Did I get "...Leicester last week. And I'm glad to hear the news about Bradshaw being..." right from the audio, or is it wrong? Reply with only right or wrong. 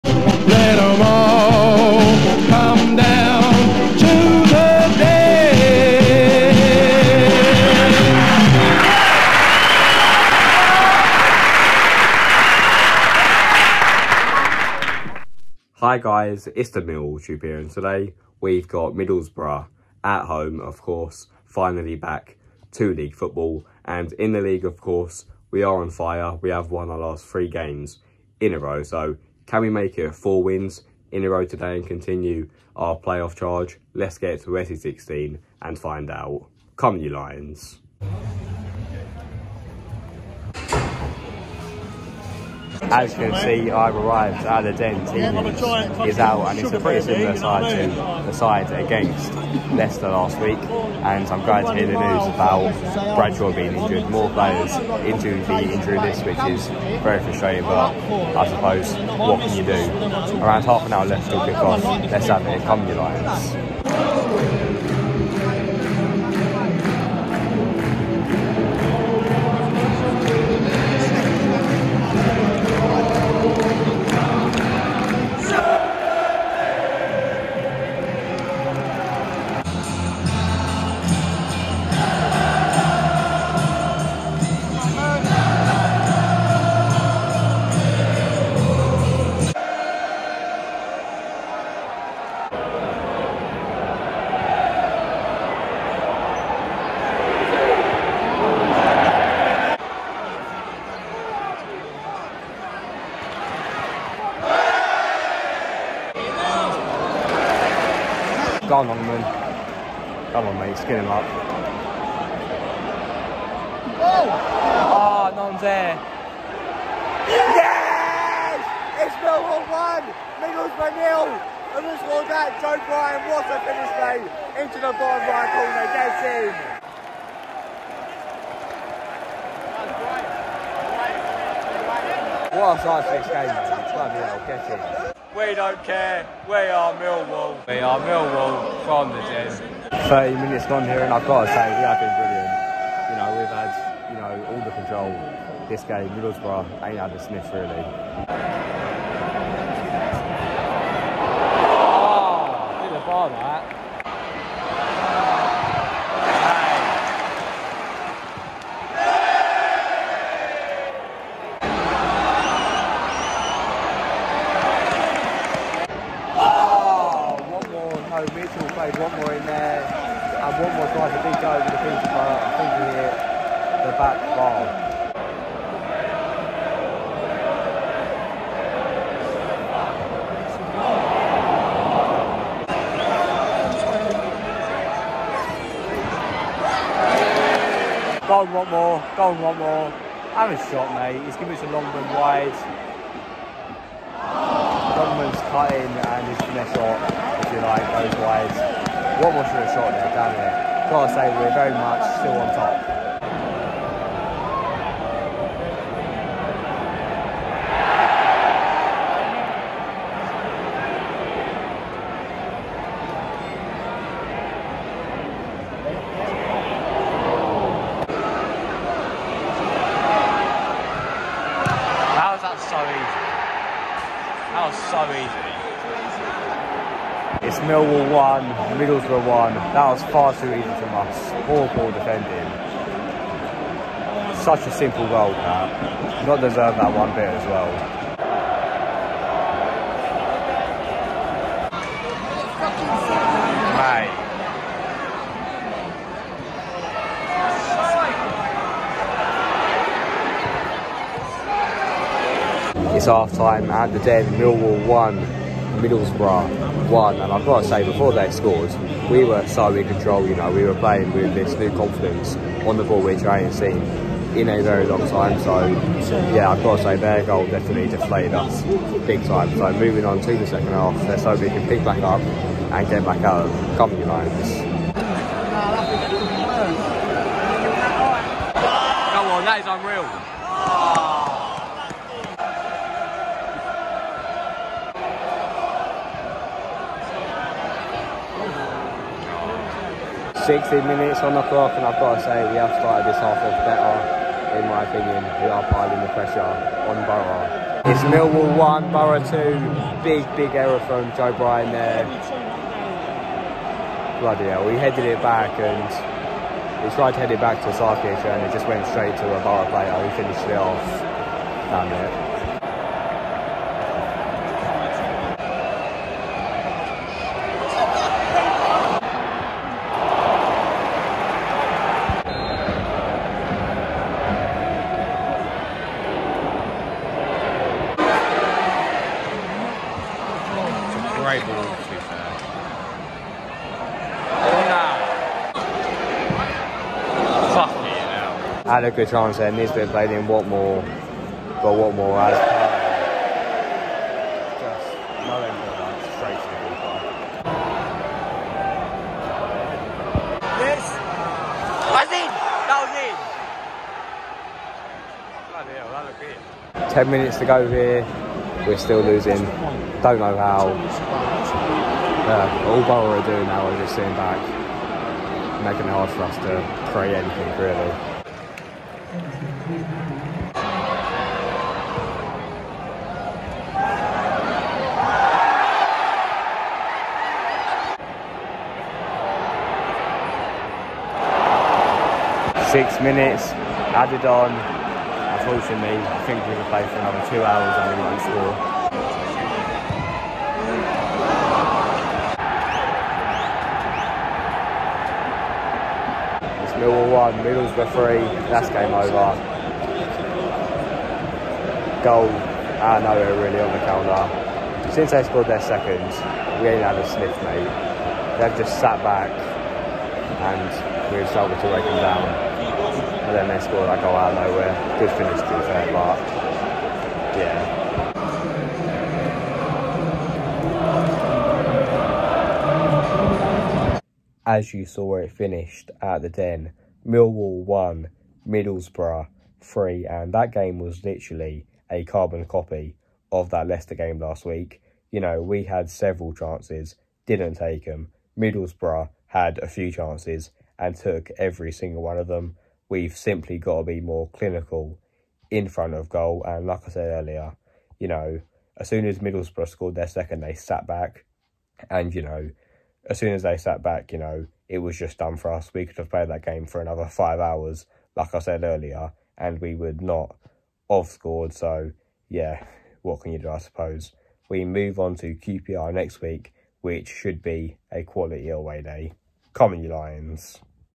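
right.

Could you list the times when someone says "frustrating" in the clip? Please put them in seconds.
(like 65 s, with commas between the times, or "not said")
57 s.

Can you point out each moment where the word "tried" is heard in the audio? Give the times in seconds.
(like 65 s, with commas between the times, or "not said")
306 s.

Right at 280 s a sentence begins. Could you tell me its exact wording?
Oh, 60 minutes on the clock, and I've got to say we have started this half off better, in my opinion.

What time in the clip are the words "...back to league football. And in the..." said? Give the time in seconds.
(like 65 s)
21 s.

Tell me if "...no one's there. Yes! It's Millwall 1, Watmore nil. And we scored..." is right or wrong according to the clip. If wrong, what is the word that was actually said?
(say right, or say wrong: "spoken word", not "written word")
wrong: "Middlesbrough", not "Watmore".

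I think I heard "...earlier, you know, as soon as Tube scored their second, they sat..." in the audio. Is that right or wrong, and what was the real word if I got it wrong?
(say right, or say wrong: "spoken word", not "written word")
wrong: "Middlesbrough", not "Tube".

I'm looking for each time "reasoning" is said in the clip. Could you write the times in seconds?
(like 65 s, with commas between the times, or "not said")
not said.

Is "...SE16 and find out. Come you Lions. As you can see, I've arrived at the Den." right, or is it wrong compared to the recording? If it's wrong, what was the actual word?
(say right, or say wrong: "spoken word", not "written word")
right.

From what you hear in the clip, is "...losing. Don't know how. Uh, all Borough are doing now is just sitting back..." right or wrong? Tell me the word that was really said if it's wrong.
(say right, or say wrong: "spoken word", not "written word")
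right.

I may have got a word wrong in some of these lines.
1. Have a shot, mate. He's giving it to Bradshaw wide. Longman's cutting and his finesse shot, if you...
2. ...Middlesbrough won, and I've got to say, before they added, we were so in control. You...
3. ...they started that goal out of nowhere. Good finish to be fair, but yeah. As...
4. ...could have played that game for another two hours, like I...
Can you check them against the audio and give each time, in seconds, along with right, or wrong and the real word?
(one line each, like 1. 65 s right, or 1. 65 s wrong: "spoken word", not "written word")
1. 190 s wrong: "Longman", not "Bradshaw"
2. 255 s wrong: "scored", not "added"
3. 413 s wrong: "scored", not "started"
4. 455 s wrong: "five", not "two".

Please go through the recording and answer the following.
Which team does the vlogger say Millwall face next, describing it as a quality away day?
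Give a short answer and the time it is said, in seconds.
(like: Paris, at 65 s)
QPR, at 465 s.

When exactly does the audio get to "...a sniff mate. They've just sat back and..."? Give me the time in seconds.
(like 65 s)
406 s.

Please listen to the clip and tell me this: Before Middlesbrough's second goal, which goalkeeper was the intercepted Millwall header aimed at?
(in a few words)
Sarkic.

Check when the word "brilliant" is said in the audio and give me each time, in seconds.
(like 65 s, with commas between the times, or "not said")
142 s.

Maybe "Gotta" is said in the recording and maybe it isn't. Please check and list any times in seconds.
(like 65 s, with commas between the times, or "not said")
200 s.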